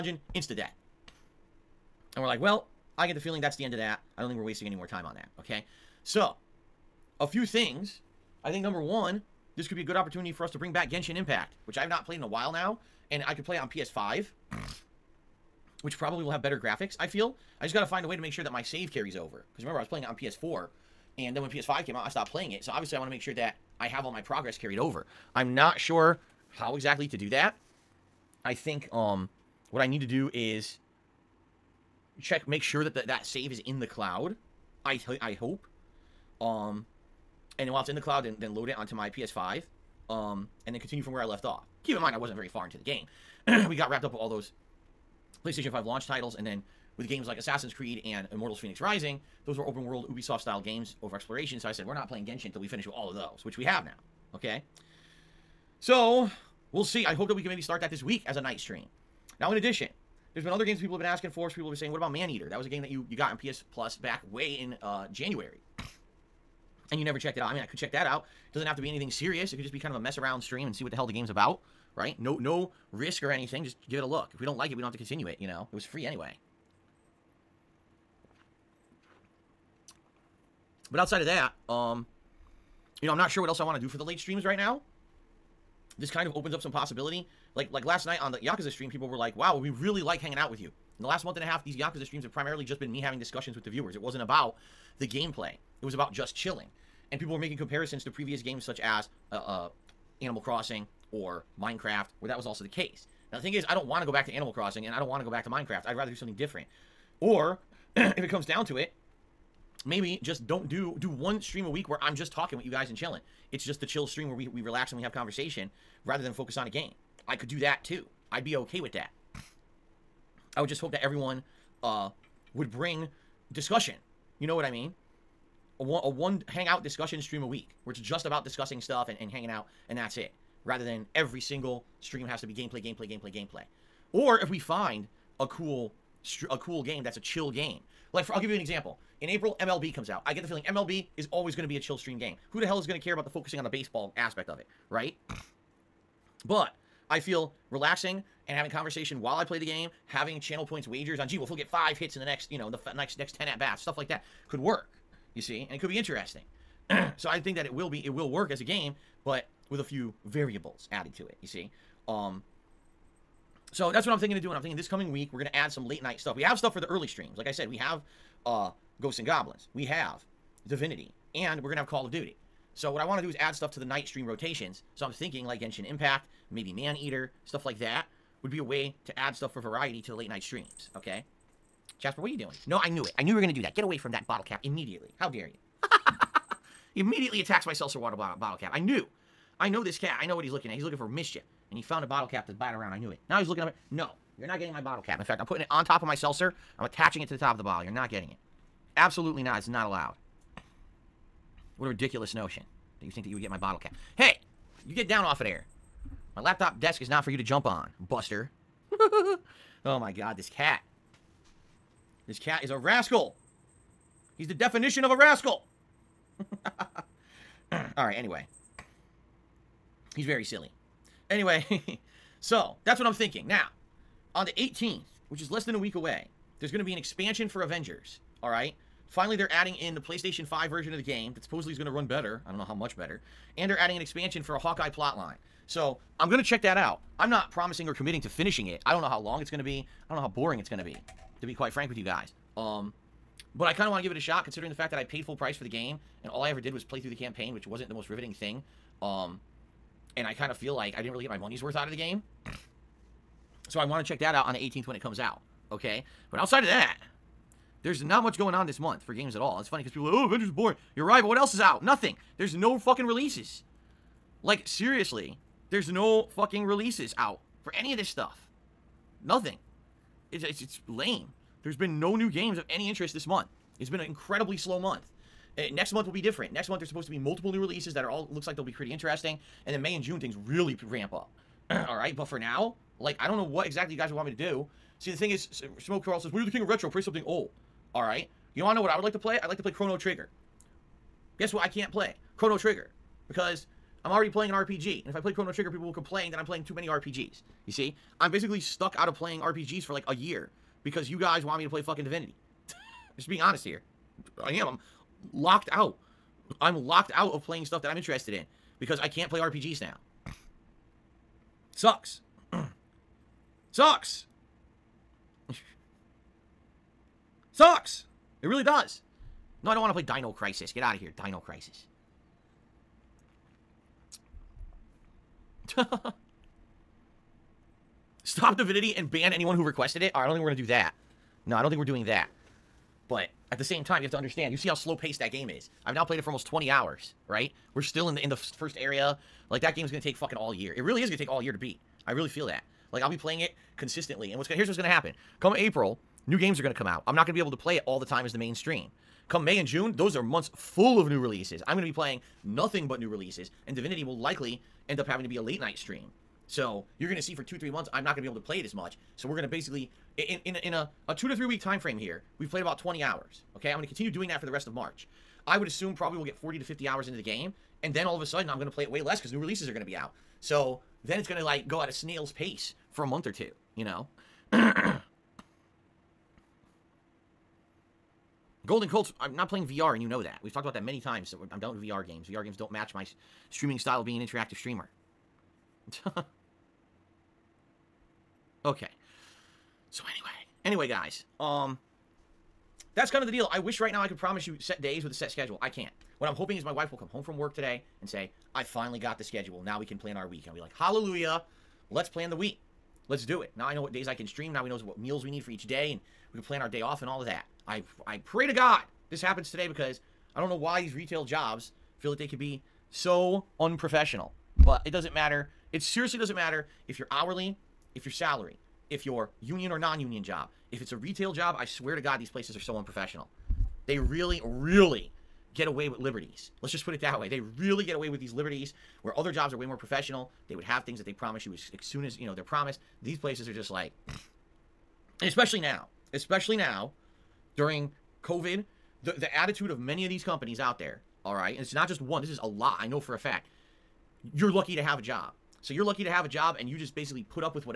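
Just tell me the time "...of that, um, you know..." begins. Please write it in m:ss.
1:21.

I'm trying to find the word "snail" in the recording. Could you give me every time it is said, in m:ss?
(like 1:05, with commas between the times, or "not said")
6:11.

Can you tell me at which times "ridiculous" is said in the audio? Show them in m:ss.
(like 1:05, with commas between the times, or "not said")
3:21.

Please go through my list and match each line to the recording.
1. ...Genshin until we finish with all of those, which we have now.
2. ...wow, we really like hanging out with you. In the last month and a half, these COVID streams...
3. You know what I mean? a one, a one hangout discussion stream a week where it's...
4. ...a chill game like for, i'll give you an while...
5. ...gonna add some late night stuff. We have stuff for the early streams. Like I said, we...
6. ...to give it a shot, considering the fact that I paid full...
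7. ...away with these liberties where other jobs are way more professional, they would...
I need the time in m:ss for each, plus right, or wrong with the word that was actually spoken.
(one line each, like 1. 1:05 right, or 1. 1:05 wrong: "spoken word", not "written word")
1. 0:52 right
2. 1:29 wrong: "Yakuza", not "COVID"
3. 2:04 right
4. 2:17 wrong: "example", not "while"
5. 2:45 right
6. 4:03 right
7. 7:07 right.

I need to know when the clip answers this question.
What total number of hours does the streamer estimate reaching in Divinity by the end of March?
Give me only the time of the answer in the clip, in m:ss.
6:06.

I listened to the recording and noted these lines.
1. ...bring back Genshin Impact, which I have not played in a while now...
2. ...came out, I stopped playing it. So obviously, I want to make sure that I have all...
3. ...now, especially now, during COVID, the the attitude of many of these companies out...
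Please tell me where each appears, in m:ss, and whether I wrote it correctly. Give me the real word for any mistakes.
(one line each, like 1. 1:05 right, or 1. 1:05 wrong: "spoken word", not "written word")
1. 0:10 right
2. 0:21 right
3. 7:15 right.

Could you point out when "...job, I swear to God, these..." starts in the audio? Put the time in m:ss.
7:01.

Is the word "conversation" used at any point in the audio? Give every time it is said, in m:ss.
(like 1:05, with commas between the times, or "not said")
1:55, 2:28.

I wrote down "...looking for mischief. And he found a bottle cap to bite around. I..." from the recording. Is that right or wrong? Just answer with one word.
right.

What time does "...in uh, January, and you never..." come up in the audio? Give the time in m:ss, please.
1:04.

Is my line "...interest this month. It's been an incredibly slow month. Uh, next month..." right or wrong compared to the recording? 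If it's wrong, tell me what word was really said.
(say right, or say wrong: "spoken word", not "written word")
right.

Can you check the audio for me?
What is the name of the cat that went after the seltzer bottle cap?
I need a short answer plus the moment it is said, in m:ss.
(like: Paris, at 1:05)
Jasper, at 3:01.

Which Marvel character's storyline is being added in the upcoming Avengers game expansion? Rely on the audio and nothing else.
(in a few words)
Hawkeye.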